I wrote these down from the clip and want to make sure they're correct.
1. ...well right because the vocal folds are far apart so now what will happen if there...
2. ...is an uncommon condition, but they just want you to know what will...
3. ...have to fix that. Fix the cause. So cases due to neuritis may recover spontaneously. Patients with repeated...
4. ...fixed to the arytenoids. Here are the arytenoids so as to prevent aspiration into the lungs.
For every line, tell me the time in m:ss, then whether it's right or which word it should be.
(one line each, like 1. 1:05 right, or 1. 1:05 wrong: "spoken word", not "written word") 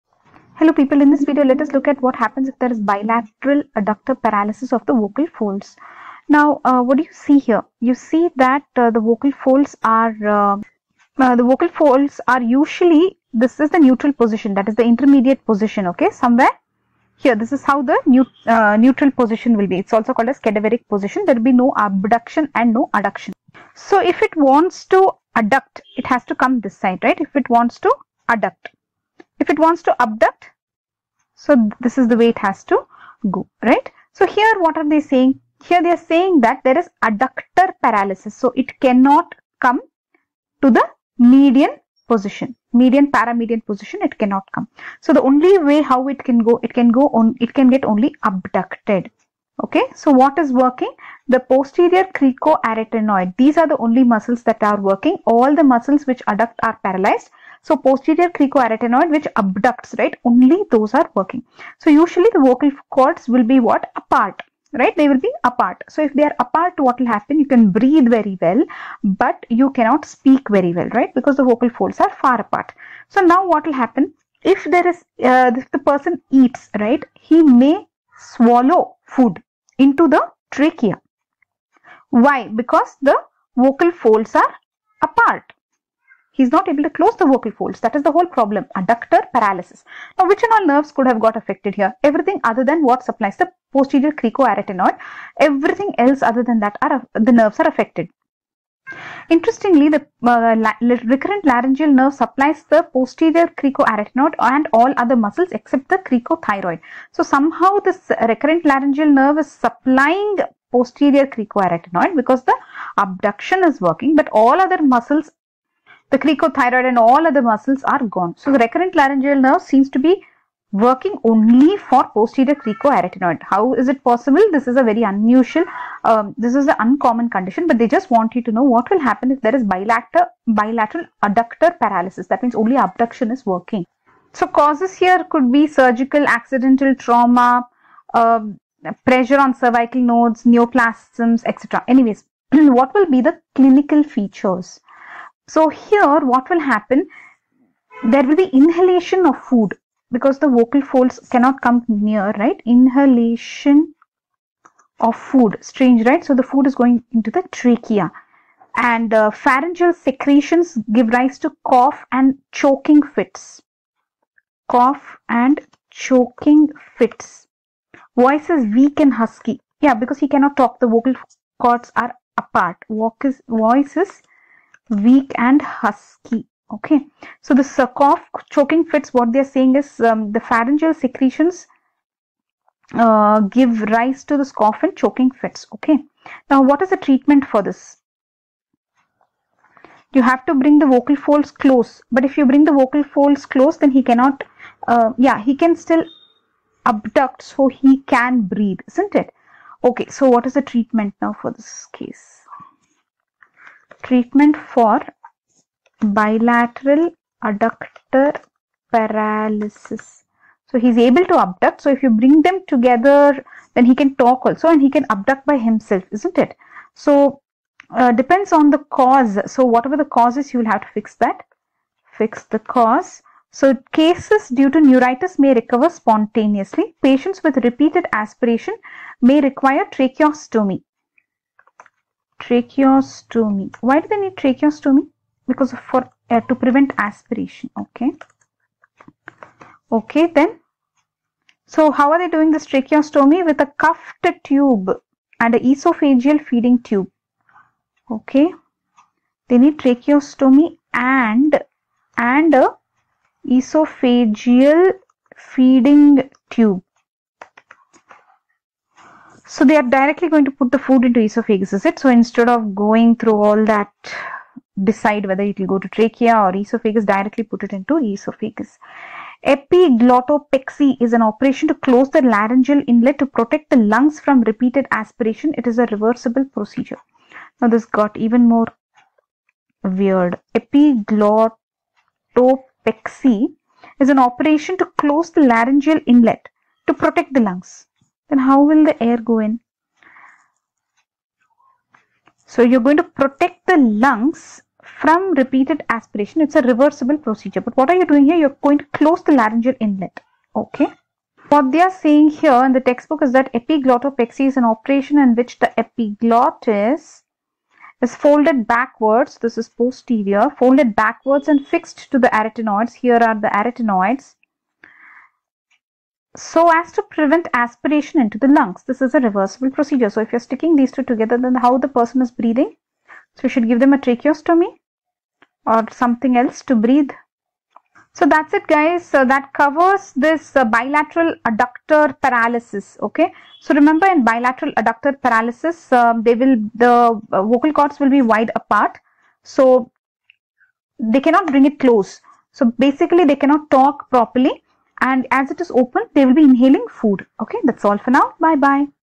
1. 1:10 right
2. 2:06 right
3. 3:40 right
4. 5:11 right.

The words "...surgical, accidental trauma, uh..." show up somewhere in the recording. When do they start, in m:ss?
2:15.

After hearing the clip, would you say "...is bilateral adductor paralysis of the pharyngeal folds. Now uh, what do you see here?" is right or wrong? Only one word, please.
wrong.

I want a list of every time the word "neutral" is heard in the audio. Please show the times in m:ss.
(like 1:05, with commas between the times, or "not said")
0:13, 0:18.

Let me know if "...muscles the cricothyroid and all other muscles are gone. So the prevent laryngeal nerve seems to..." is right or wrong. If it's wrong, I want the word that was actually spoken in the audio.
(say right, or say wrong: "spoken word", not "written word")
wrong: "recurrent", not "prevent".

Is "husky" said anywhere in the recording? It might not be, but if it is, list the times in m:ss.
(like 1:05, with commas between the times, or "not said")
2:49, 2:55.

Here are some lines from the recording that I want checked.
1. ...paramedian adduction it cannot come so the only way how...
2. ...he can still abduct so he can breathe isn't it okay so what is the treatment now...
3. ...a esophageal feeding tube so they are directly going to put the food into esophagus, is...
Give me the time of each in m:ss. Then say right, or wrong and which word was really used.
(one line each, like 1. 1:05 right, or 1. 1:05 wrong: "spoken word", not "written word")
1. 0:43 wrong: "position", not "adduction"
2. 3:15 right
3. 4:12 right.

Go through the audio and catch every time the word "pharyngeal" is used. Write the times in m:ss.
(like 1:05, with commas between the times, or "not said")
2:39, 3:00.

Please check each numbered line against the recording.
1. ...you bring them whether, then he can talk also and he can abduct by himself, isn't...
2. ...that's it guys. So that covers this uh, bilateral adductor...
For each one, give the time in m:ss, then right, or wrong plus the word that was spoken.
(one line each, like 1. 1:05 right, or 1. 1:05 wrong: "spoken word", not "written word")
1. 3:32 wrong: "together", not "whether"
2. 5:28 right.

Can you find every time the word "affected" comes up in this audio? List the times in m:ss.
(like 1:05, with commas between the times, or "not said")
1:31, 1:37.